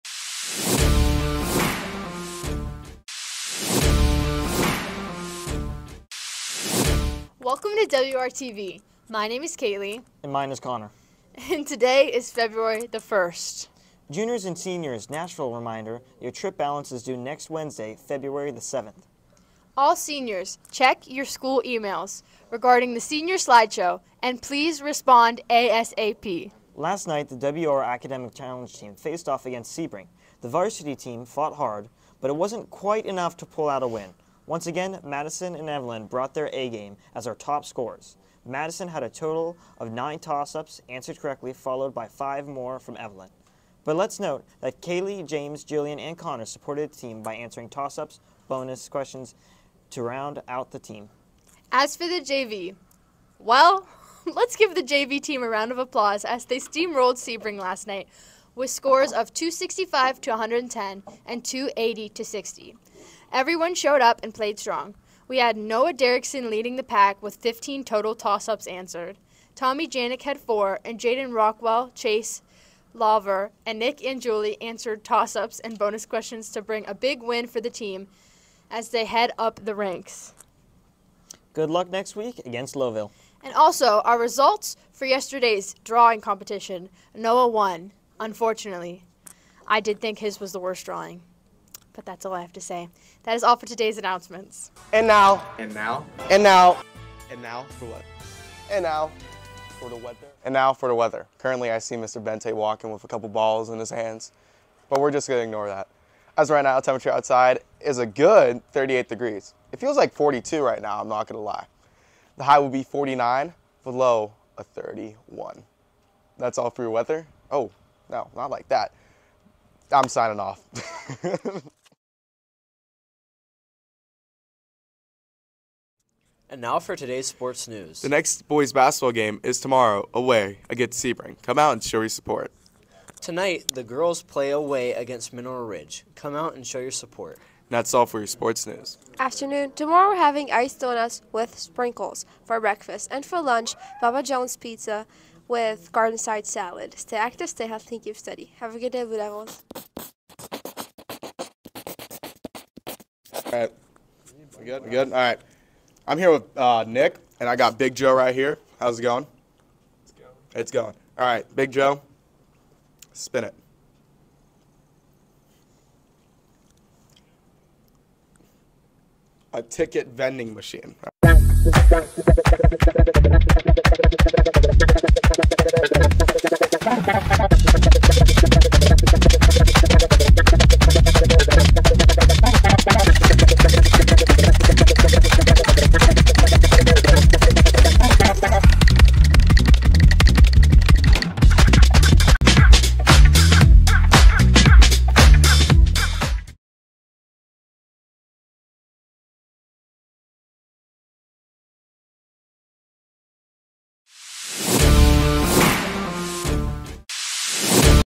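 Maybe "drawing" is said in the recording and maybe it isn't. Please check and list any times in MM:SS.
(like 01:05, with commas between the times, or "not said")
01:25, 01:30.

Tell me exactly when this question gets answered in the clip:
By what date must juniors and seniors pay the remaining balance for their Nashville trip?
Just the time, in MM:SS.
00:18.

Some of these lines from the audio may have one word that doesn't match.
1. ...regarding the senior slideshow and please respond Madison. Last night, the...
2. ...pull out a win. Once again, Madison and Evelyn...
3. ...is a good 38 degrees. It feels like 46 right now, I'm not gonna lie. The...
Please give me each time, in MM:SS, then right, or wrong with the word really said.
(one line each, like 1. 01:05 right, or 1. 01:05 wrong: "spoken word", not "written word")
1. 00:22 wrong: "ASAP", not "Madison"
2. 00:33 right
3. 01:47 wrong: "42", not "46".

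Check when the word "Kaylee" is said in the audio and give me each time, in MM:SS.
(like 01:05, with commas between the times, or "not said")
00:09, 00:44.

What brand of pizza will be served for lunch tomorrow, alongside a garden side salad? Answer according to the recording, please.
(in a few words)
Papa John's.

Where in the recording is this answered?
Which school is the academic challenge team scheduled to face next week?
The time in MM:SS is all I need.
01:22.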